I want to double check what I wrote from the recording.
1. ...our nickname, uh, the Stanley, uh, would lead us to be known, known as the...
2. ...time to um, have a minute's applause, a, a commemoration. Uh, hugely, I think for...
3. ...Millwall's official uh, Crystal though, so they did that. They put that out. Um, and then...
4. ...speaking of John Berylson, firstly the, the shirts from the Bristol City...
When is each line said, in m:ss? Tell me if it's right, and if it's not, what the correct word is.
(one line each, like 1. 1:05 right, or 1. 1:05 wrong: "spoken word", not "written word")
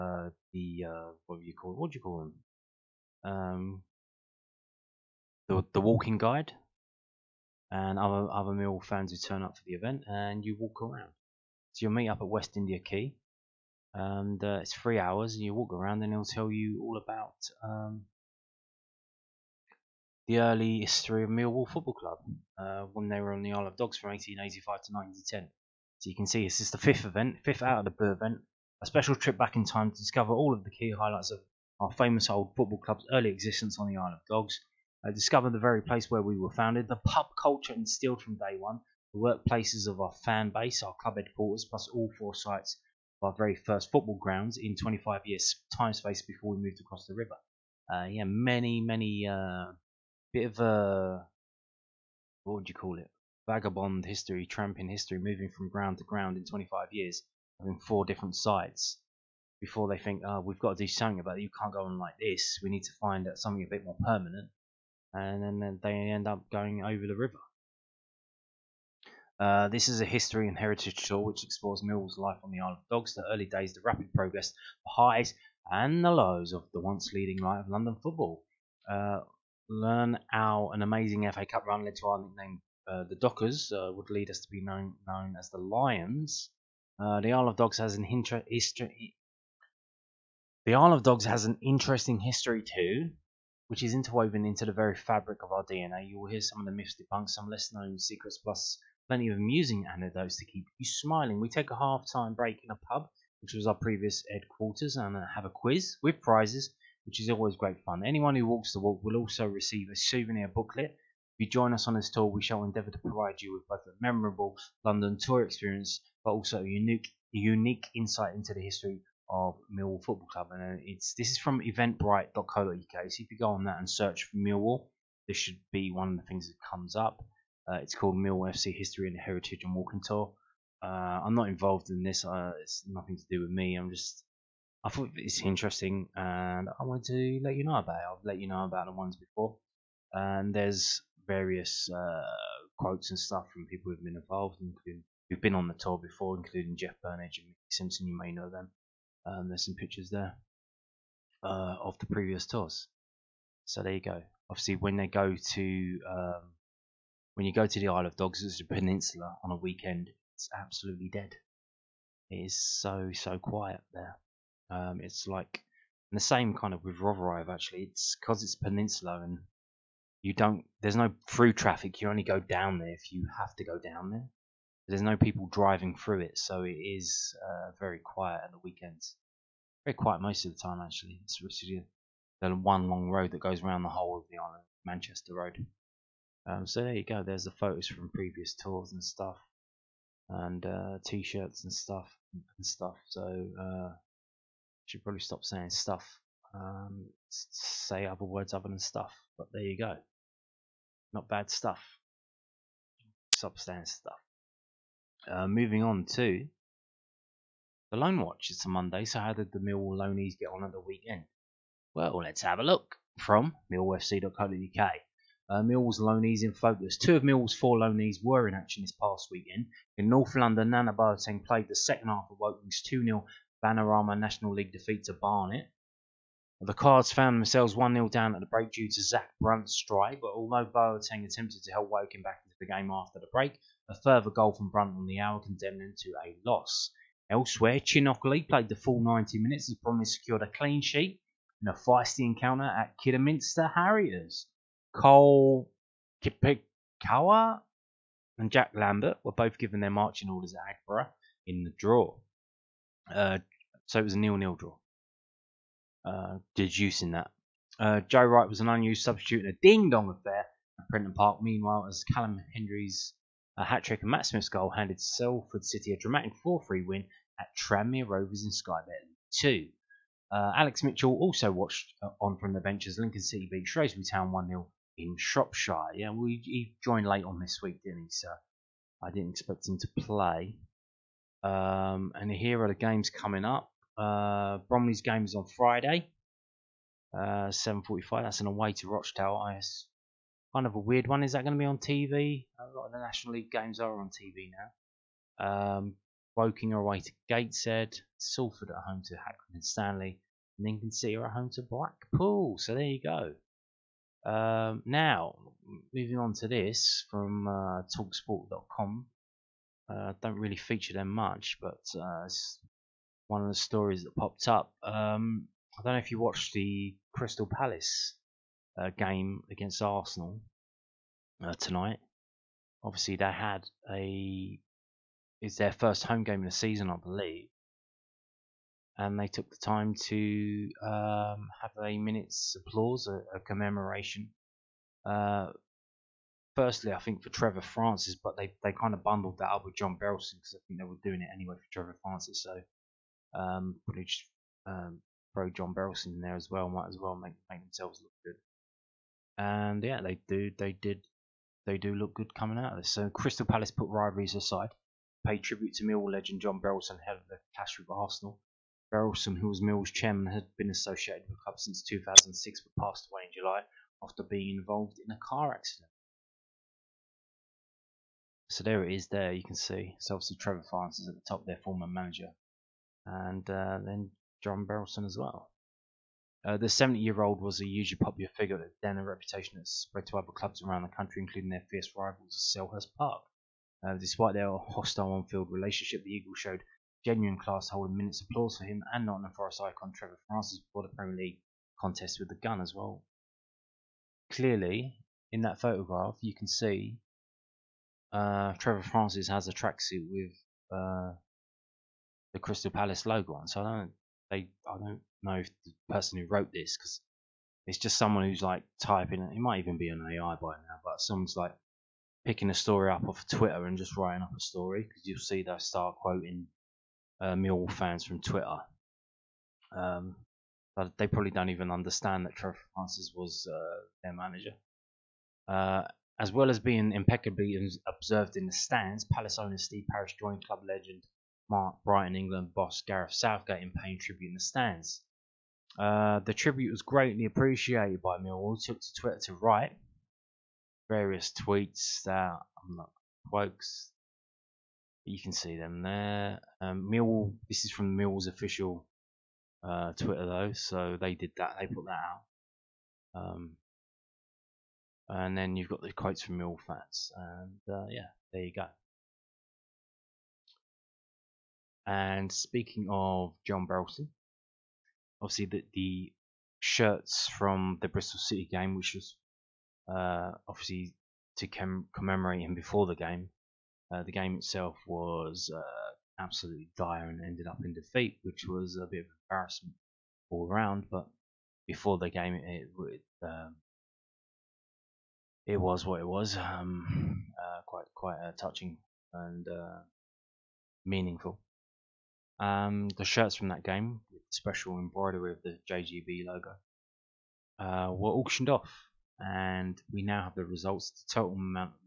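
1. 1:22 wrong: "Dockers", not "Stanley"
2. 5:29 wrong: "firstly", not "hugely"
3. 7:27 wrong: "Twitter", not "Crystal"
4. 7:42 wrong: "obviously", not "firstly".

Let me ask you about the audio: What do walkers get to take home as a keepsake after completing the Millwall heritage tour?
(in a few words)
Souvenir booklet.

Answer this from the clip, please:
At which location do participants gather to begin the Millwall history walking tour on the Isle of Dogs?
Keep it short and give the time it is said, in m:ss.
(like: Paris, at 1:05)
West India Quay, at 0:12.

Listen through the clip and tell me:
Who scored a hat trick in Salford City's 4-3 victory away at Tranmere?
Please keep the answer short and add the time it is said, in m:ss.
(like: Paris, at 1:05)
Callum Hendry, at 4:22.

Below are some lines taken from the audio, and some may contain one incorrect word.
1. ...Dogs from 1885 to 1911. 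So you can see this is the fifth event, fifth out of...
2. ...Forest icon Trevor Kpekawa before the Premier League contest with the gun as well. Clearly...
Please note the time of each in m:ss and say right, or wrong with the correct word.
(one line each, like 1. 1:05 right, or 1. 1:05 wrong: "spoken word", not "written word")
1. 0:23 wrong: "1910", not "1911"
2. 6:29 wrong: "Francis", not "Kpekawa".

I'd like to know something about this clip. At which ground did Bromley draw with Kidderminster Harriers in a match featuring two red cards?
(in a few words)
Aggborough.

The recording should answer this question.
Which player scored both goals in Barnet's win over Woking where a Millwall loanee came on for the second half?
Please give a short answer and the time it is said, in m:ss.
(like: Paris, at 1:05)
Zak Brunt, at 3:49.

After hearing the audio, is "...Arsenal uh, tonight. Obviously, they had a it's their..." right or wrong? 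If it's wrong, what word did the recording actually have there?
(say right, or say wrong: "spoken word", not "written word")
right.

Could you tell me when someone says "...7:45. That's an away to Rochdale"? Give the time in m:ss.
4:47.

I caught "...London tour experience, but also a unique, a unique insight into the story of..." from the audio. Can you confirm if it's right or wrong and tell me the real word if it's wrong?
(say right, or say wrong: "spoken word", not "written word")
wrong: "history", not "story".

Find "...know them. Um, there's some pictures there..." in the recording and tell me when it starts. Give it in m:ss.
2:28.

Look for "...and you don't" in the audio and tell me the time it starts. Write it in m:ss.
2:49.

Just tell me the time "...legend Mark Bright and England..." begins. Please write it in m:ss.
7:10.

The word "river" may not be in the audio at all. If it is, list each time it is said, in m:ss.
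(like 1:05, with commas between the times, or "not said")
0:47, 1:07.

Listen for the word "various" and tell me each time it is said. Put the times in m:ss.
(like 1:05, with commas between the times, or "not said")
2:21, 7:20.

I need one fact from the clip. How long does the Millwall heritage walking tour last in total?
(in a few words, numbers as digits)
3 hours.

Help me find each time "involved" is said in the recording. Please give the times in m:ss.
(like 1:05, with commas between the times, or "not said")
2:11, 2:24, 6:04.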